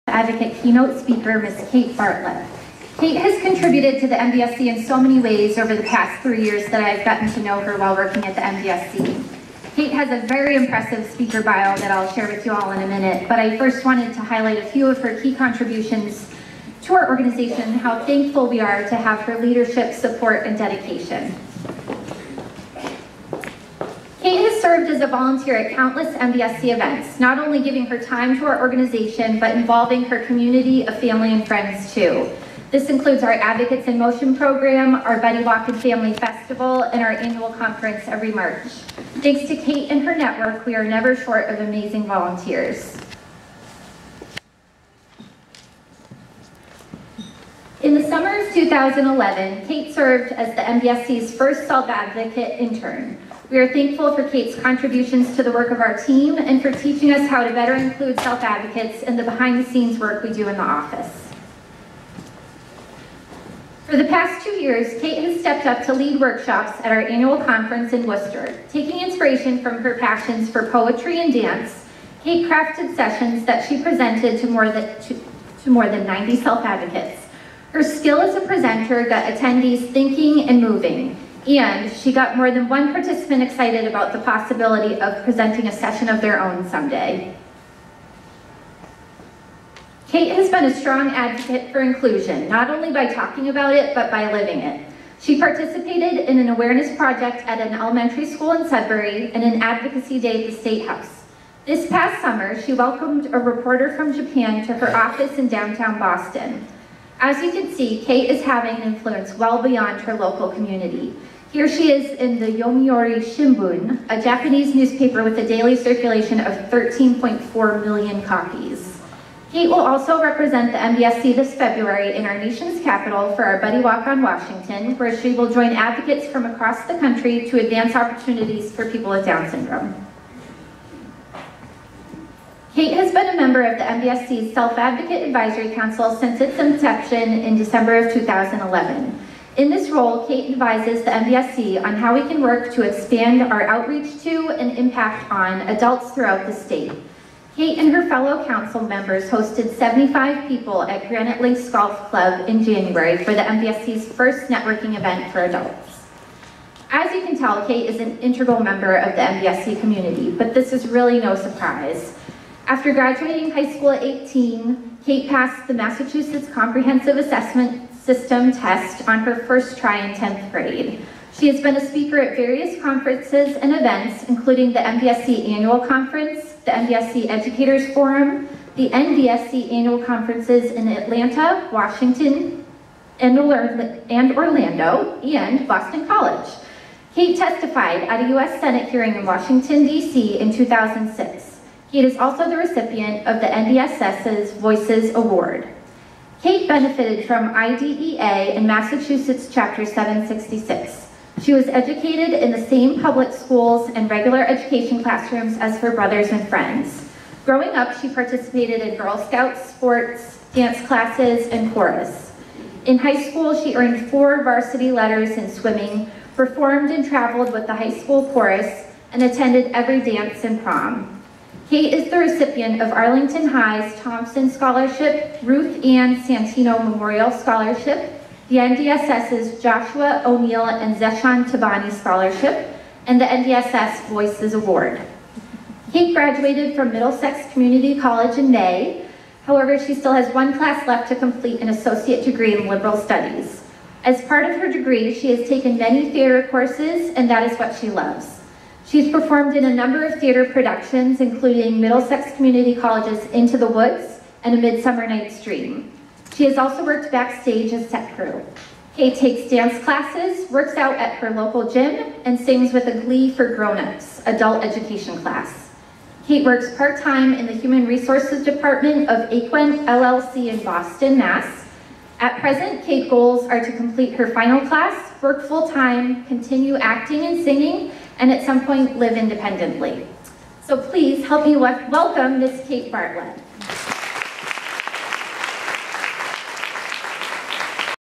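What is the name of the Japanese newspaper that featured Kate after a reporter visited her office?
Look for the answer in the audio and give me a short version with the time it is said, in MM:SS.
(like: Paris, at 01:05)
Yomiuri Shimbun, at 01:52.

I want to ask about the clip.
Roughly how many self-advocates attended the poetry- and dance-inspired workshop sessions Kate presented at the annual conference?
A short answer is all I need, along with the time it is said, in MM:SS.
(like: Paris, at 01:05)
more than 90, at 01:15.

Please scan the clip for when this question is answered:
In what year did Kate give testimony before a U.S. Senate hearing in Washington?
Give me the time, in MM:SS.
03:10.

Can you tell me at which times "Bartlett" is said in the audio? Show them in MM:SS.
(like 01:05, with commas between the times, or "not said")
00:01, 04:42.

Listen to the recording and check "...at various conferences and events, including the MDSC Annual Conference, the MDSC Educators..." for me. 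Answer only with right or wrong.
right.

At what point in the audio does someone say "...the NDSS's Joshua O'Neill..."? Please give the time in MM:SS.
03:48.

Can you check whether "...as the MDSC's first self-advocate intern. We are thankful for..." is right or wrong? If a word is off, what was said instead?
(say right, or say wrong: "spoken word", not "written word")
right.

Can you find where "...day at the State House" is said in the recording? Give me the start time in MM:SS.
01:40.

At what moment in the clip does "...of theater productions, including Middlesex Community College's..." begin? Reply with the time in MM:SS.
04:10.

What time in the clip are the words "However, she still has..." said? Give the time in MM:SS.
03:59.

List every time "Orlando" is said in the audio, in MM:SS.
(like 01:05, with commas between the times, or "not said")
03:03.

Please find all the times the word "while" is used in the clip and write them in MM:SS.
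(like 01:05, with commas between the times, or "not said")
00:07.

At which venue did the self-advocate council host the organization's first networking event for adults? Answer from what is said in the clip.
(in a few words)
Granite Links Golf Club.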